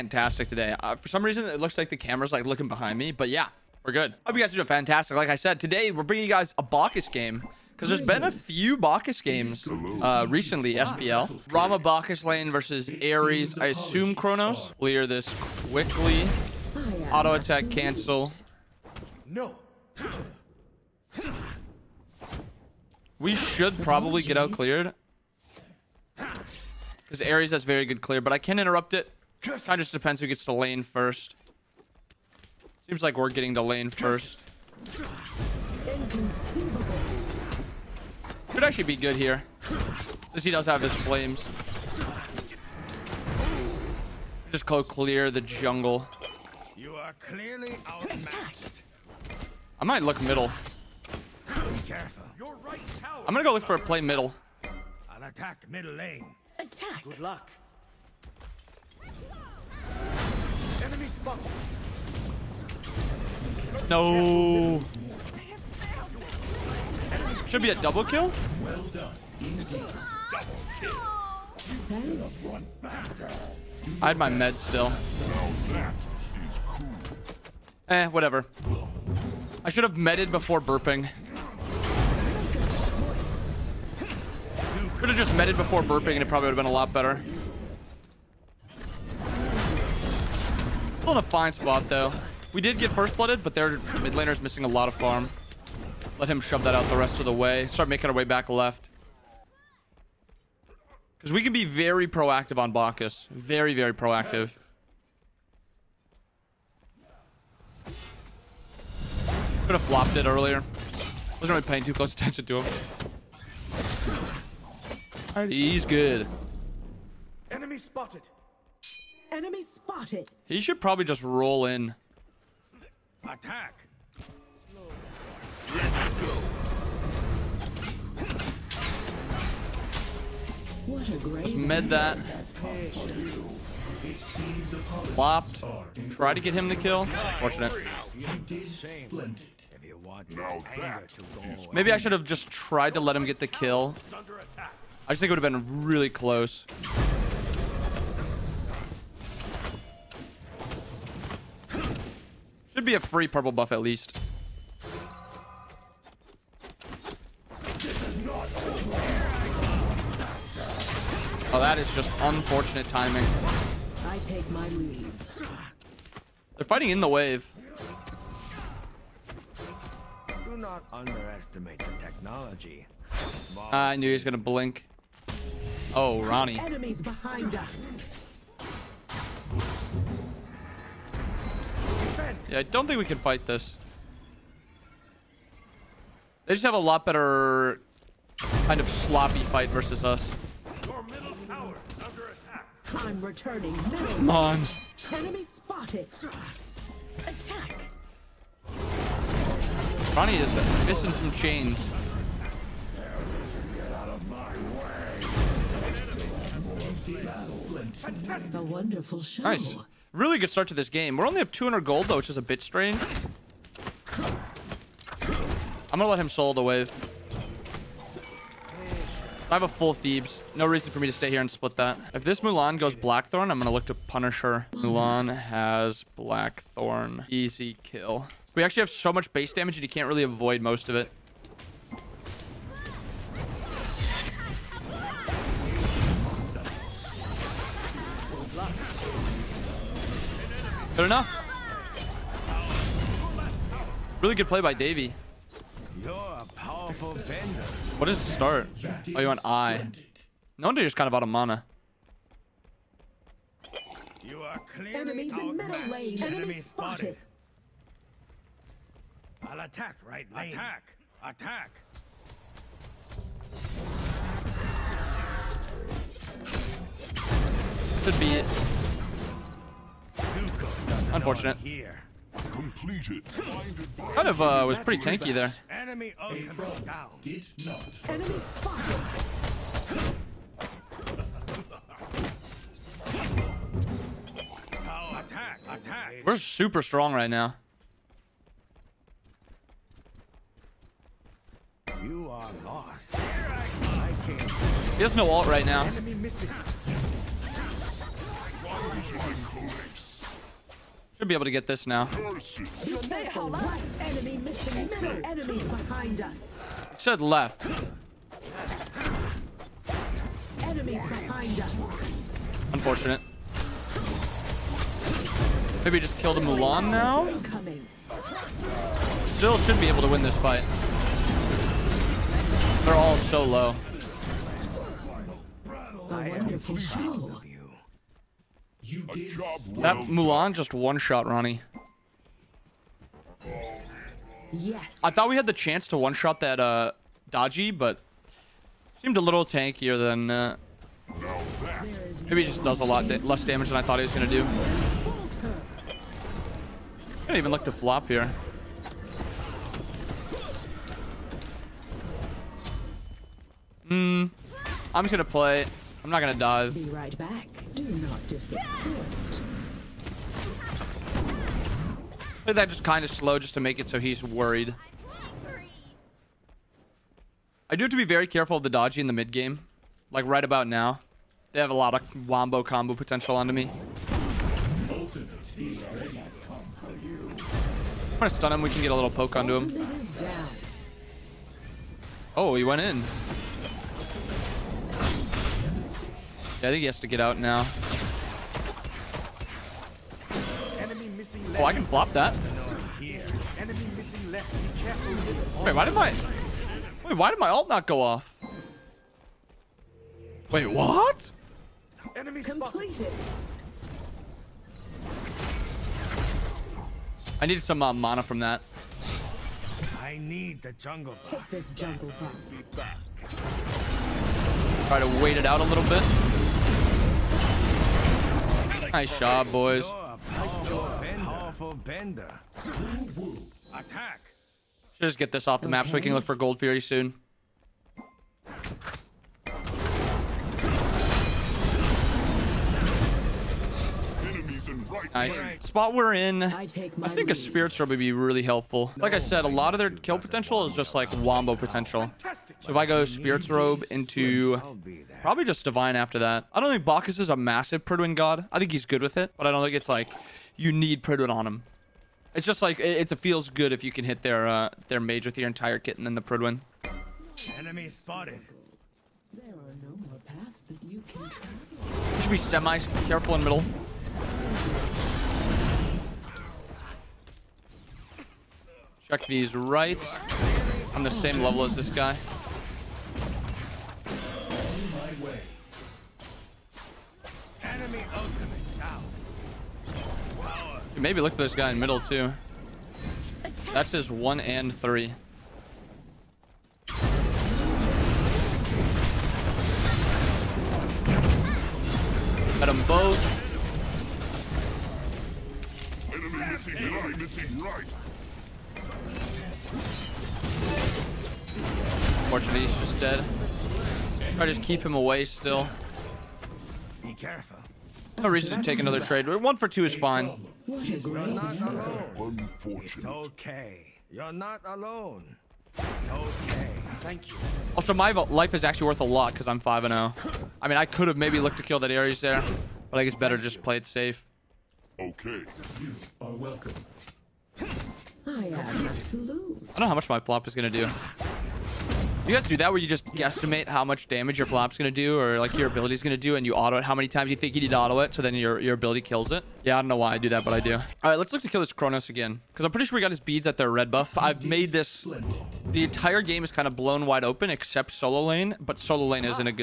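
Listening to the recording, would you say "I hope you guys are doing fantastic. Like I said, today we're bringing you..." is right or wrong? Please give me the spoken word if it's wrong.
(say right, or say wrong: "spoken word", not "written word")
right.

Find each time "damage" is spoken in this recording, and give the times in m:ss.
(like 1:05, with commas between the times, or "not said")
3:49, 5:43, 8:54.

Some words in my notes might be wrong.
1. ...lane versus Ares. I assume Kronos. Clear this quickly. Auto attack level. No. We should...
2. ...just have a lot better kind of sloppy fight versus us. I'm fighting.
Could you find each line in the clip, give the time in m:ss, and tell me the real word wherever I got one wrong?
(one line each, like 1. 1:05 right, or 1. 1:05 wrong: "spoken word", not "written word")
1. 0:12 wrong: "cancel", not "level"
2. 3:06 wrong: "returning", not "fighting".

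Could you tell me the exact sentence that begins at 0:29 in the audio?
Kind of just depends who gets the lane first.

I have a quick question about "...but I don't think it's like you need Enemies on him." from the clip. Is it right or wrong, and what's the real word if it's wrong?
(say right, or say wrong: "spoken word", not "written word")
wrong: "Pridwen", not "Enemies".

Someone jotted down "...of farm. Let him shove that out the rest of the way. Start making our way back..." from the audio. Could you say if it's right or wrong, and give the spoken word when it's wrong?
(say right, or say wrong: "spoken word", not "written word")
right.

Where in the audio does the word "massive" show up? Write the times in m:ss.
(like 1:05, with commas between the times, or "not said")
7:27.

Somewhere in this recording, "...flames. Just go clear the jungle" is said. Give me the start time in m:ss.
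0:40.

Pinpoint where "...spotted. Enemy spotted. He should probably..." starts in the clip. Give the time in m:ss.
1:57.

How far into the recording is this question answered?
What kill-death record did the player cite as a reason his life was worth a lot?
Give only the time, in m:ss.
8:39.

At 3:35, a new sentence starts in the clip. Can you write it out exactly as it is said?
I'm gonna let him solo the wave.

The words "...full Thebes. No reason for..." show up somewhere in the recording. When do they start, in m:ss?
3:39.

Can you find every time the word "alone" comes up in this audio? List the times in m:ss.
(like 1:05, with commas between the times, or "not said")
8:34.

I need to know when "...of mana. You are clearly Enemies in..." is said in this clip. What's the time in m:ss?
4:11.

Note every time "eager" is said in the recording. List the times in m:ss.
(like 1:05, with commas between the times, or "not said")
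not said.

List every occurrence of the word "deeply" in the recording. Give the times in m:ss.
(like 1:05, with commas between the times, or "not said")
not said.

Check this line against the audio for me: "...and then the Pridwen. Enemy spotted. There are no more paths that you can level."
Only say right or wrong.
wrong.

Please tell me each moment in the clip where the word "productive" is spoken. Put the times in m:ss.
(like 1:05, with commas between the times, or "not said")
not said.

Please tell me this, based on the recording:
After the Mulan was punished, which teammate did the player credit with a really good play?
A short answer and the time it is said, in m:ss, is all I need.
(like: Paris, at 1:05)
Davy, at 4:04.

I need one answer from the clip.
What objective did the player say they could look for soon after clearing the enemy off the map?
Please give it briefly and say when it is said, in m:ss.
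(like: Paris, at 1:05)
Gold Fury, at 7:06.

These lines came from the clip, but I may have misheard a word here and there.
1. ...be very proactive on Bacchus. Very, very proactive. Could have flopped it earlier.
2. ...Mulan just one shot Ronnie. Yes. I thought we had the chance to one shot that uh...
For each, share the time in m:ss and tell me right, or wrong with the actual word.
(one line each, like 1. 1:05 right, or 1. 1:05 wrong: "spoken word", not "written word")
1. 1:41 right
2. 5:30 right.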